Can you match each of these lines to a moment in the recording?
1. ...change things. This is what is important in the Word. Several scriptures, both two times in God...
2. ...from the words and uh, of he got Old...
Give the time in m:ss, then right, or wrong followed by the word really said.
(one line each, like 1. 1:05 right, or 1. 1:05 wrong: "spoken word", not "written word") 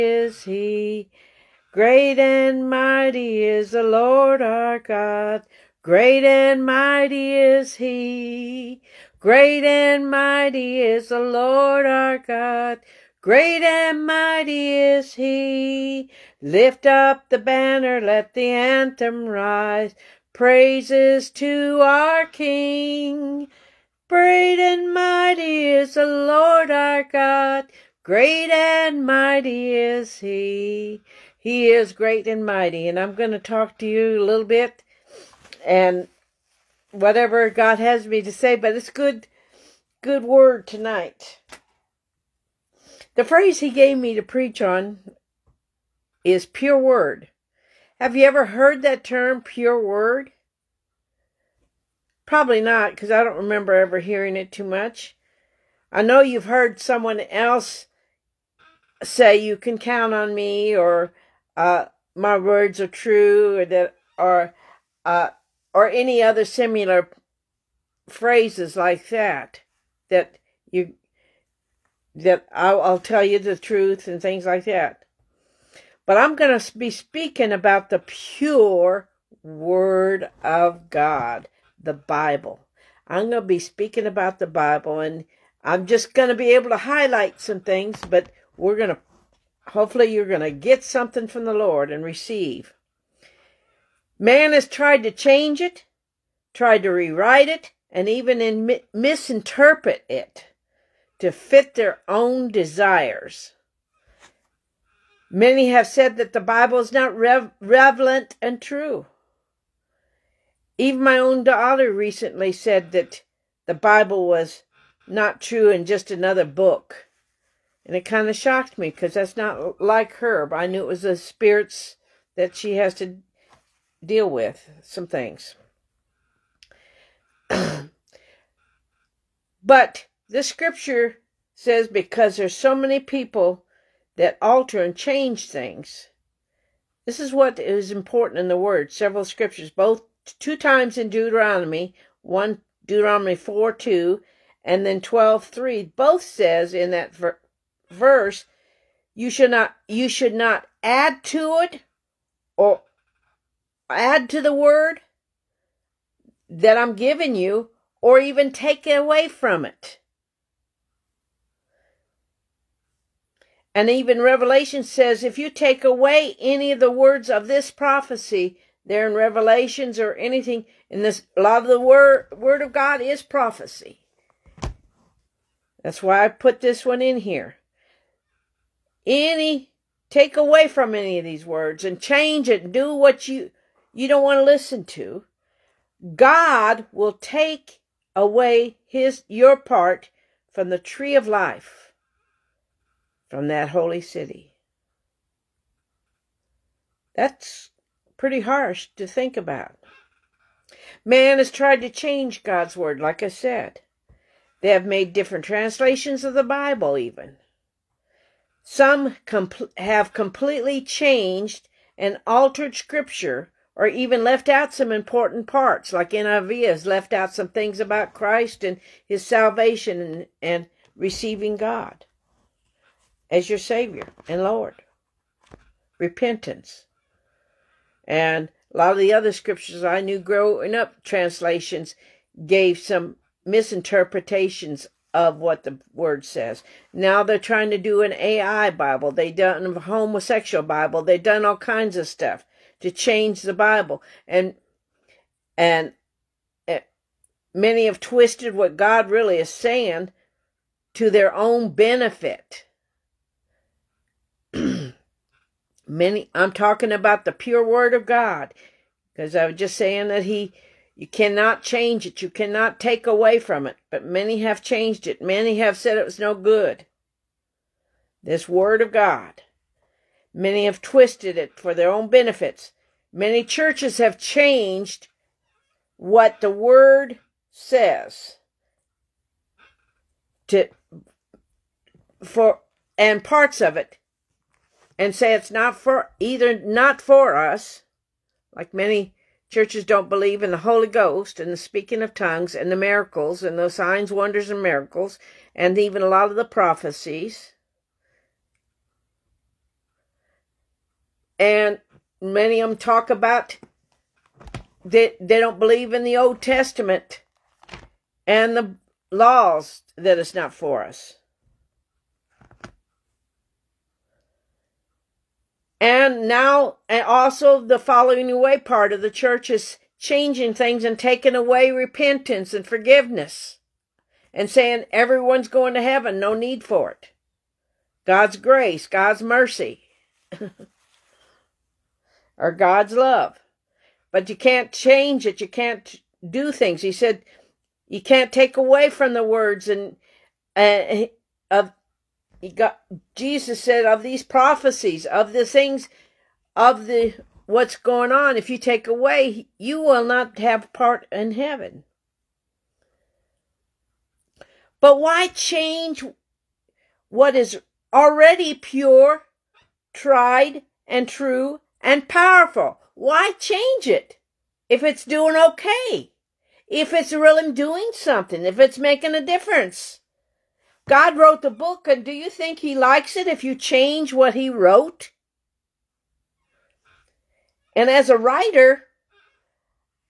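1. 2:14 wrong: "Deuteronomy", not "God"
2. 5:38 wrong: "Jesus", not "Old".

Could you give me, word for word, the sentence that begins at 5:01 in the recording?
And many of them talk about that they don't believe in the Old Testament and the laws that it's not for us.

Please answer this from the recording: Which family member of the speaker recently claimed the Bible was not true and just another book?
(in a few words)
daughter.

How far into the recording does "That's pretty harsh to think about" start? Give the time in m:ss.
3:17.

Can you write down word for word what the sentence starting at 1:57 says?
And it kind of shocked me because that's not like her.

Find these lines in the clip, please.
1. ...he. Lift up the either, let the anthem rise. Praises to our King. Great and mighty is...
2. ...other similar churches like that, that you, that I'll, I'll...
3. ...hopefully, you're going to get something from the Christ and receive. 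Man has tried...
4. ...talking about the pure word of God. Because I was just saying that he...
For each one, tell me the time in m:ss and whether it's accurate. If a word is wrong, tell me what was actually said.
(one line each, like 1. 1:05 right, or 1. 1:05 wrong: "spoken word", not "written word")
1. 0:15 wrong: "banner", not "either"
2. 1:06 wrong: "phrases", not "churches"
3. 1:29 wrong: "Lord", not "Christ"
4. 4:16 right.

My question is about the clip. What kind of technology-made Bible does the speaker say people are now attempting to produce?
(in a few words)
AI Bible.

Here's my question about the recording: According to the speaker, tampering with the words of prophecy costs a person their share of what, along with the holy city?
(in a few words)
the tree of life.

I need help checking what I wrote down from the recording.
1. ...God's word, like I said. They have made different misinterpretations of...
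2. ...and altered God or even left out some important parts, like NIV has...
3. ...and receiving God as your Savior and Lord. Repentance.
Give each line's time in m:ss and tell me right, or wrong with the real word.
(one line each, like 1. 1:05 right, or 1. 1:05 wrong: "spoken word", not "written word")
1. 3:22 wrong: "translations", not "misinterpretations"
2. 3:31 wrong: "Scripture", not "God"
3. 3:40 right.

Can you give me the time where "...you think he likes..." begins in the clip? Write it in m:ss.
6:12.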